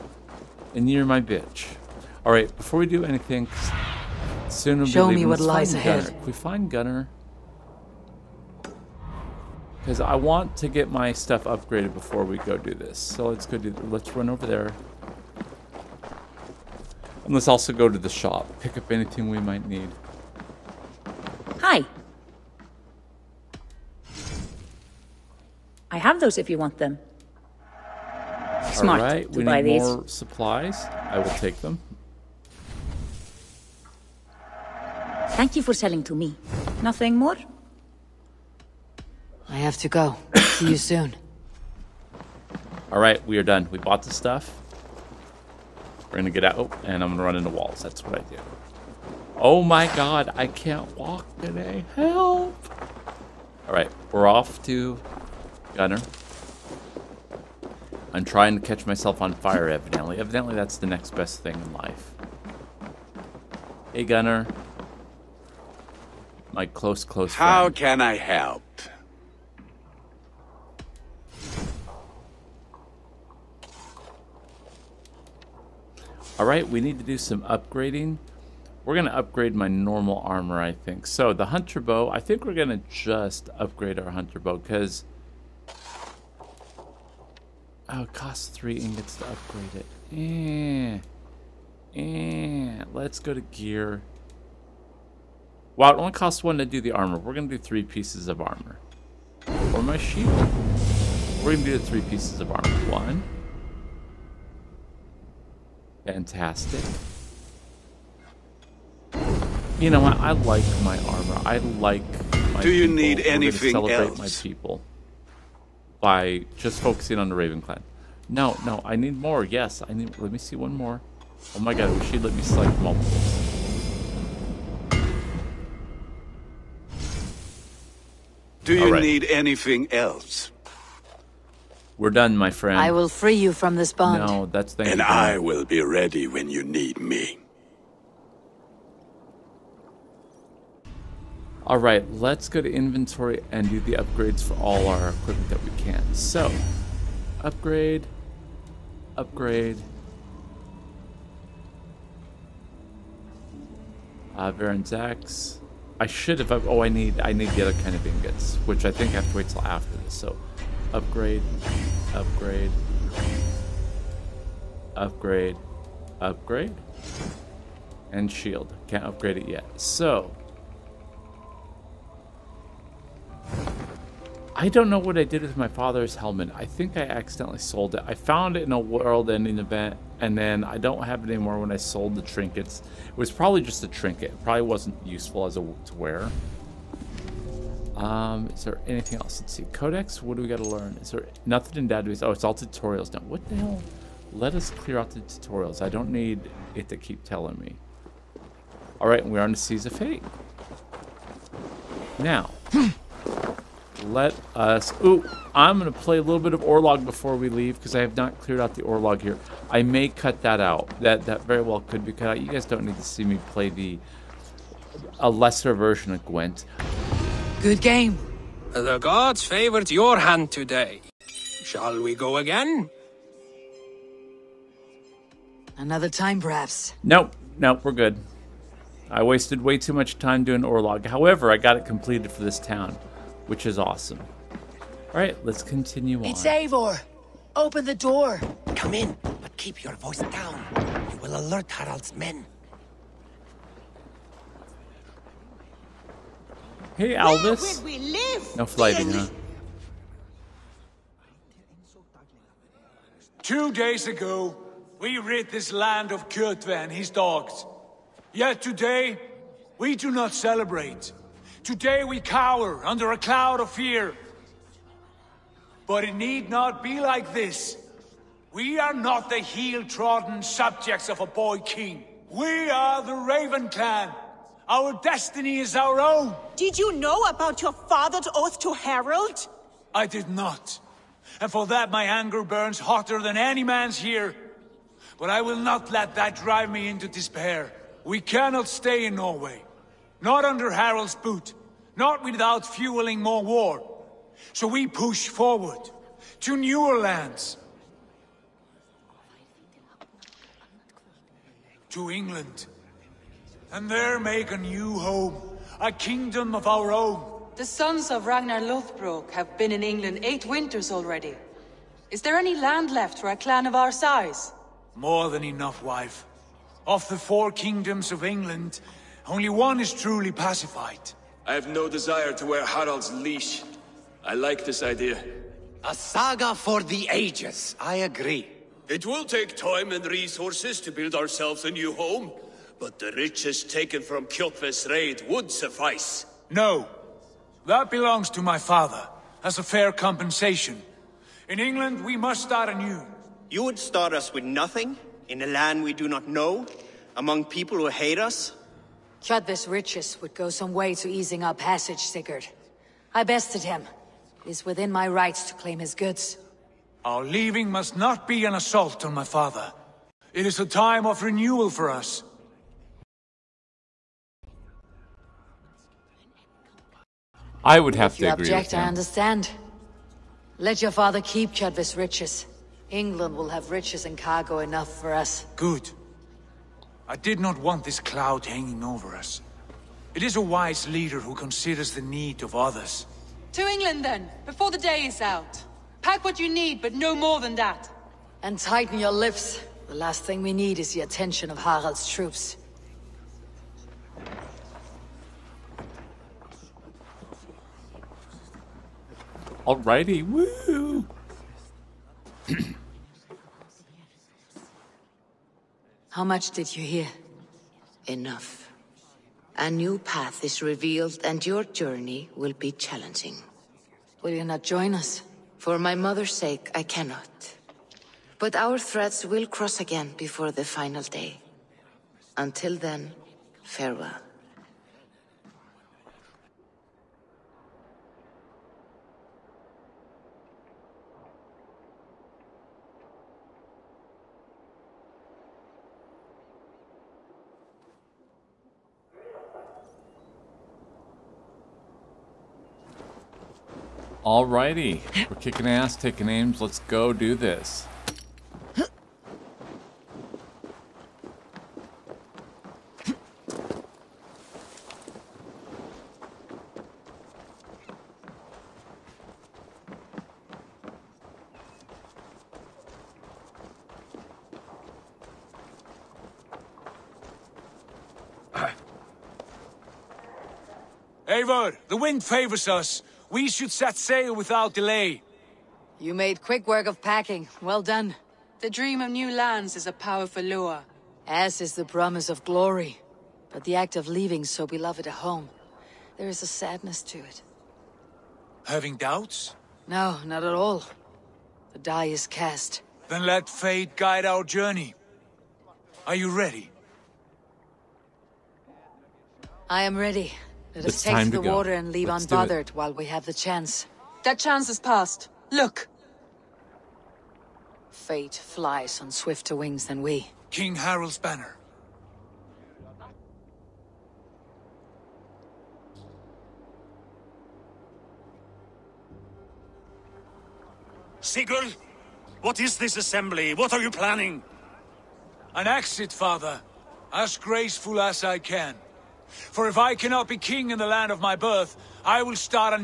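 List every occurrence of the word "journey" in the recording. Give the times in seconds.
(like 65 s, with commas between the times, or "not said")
411 s, 494 s.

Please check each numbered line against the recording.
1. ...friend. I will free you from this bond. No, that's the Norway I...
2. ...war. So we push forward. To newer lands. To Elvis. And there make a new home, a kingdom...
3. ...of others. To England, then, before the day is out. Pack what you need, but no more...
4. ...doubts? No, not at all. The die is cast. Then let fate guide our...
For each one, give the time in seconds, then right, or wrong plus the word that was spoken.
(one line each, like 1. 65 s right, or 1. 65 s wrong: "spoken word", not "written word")
1. 132 s wrong: "And", not "Norway"
2. 293 s wrong: "England", not "Elvis"
3. 382 s right
4. 488 s right.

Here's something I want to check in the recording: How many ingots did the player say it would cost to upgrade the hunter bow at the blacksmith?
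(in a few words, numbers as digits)
3.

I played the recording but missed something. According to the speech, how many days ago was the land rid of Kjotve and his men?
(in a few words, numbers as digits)
2.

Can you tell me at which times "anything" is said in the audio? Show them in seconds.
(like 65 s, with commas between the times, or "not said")
3 s, 18 s, 113 s, 129 s, 188 s.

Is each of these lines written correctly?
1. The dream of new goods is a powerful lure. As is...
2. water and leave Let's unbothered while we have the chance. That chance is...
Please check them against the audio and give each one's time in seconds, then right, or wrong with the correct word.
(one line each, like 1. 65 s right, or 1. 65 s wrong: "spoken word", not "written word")
1. 478 s wrong: "lands", not "goods"
2. 501 s right.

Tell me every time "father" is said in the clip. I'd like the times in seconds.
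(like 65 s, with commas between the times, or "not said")
175 s, 277 s, 338 s, 359 s, 370 s, 526 s.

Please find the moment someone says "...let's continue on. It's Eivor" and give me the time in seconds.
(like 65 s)
235 s.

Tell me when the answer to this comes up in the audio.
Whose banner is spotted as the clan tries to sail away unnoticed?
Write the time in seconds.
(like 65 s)
510 s.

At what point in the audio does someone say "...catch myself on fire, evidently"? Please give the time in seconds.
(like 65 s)
58 s.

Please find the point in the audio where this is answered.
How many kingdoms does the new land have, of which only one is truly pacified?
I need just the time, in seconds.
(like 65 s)
317 s.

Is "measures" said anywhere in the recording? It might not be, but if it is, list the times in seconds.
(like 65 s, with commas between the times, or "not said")
not said.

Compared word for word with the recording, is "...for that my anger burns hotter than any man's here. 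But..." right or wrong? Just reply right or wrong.
right.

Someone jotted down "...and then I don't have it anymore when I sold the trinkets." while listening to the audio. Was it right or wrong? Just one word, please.
right.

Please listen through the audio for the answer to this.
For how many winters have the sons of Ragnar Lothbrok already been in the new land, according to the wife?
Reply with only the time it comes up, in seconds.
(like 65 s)
310 s.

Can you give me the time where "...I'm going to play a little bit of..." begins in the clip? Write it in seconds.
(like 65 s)
205 s.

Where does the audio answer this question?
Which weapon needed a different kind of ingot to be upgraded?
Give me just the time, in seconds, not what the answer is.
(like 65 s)
154 s.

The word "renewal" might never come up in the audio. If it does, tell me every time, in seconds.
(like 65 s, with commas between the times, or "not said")
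361 s.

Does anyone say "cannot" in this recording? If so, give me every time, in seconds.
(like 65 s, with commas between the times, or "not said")
288 s, 416 s, 529 s.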